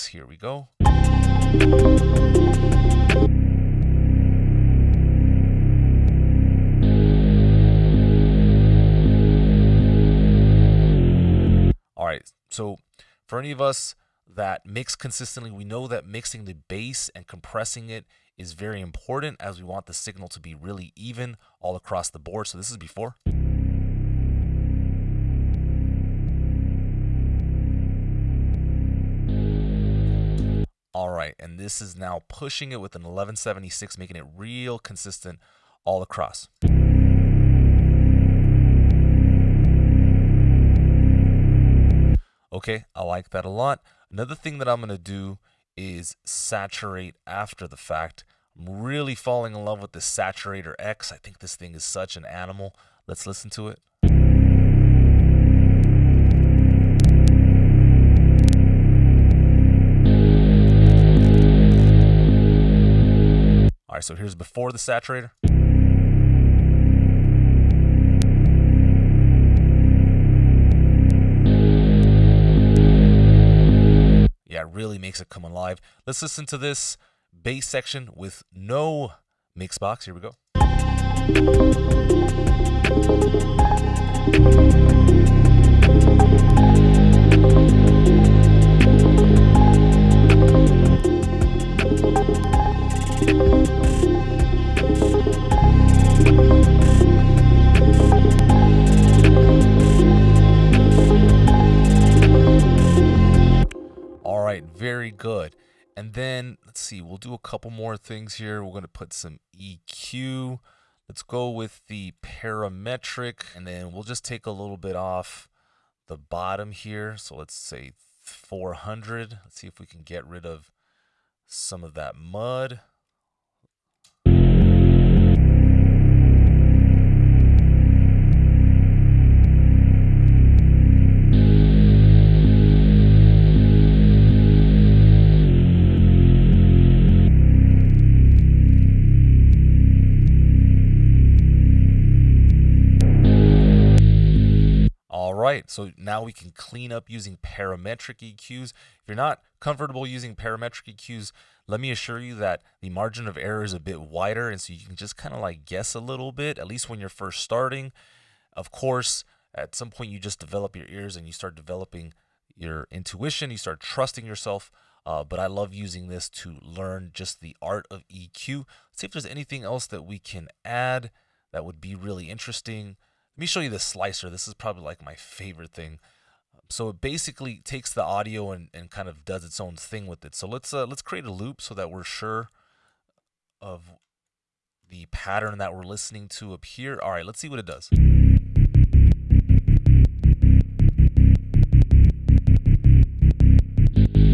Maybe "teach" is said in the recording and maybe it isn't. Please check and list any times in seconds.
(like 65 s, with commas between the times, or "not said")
not said.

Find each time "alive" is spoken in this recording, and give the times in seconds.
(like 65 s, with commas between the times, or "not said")
75 s.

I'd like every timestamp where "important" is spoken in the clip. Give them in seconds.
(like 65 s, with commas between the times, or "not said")
18 s.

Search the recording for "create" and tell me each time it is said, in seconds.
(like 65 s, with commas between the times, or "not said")
181 s.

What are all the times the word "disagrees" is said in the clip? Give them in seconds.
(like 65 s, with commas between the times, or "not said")
not said.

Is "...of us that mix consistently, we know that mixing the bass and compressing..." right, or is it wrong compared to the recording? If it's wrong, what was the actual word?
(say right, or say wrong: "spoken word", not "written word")
right.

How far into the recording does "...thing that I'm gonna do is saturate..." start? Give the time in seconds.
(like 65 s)
44 s.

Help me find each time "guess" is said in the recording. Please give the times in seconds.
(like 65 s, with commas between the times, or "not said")
155 s.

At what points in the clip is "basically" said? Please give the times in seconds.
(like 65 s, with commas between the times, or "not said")
177 s.